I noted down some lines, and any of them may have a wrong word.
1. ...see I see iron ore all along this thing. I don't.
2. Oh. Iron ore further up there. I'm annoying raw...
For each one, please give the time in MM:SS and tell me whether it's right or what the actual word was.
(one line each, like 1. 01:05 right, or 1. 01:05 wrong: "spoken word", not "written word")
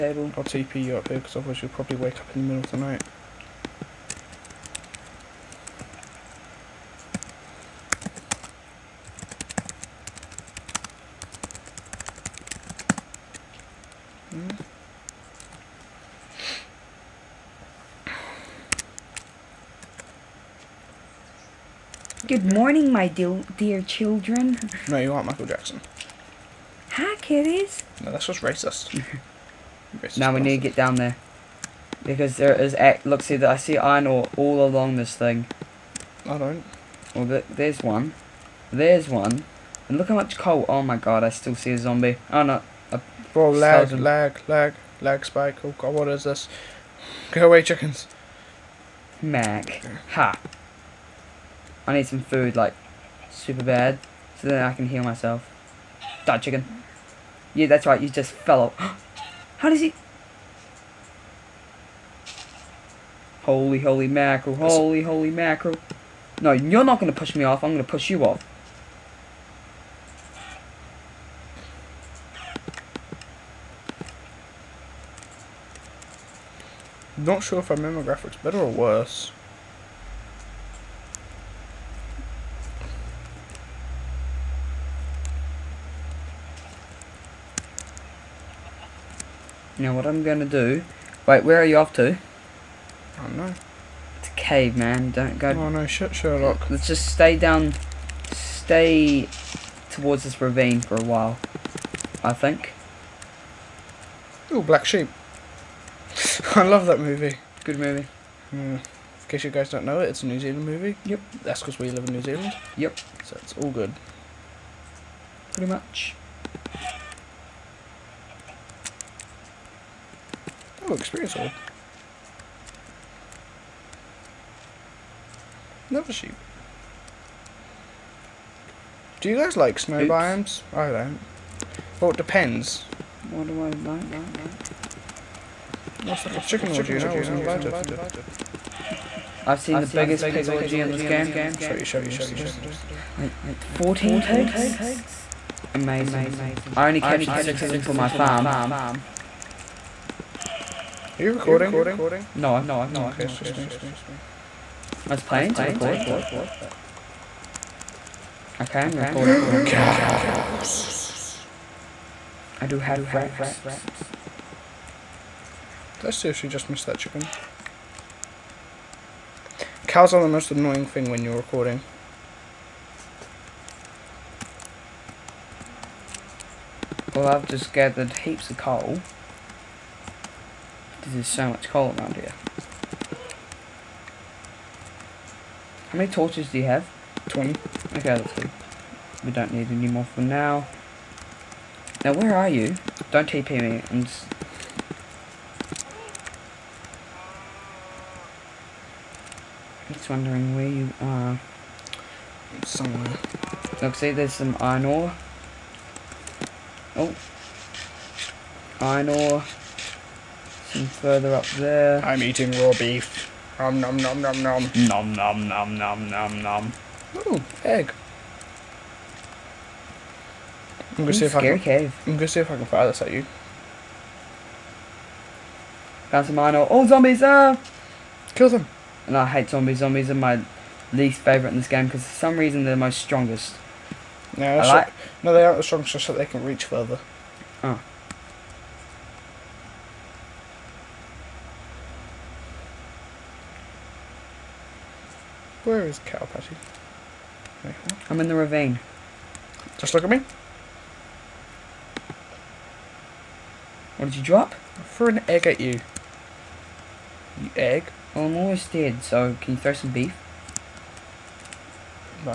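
1. 00:33 right
2. 03:26 wrong: "eating", not "annoying".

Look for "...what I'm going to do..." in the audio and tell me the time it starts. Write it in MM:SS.
01:29.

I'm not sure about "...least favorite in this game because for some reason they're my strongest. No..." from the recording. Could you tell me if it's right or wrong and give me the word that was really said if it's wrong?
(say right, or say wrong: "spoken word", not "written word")
right.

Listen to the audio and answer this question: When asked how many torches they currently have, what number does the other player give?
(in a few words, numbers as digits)
20.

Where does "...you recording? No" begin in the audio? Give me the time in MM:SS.
02:31.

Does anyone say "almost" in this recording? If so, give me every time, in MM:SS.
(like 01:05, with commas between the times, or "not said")
04:18.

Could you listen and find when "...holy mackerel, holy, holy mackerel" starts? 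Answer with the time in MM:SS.
01:03.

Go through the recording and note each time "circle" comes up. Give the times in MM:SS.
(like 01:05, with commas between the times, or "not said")
not said.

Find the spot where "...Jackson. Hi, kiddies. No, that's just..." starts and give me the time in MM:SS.
00:25.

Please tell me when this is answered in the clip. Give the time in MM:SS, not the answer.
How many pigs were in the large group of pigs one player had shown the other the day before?
02:23.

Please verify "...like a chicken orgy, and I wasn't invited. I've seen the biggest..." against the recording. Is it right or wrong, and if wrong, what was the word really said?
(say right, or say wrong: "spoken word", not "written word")
right.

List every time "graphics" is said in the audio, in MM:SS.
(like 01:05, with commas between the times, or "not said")
01:18.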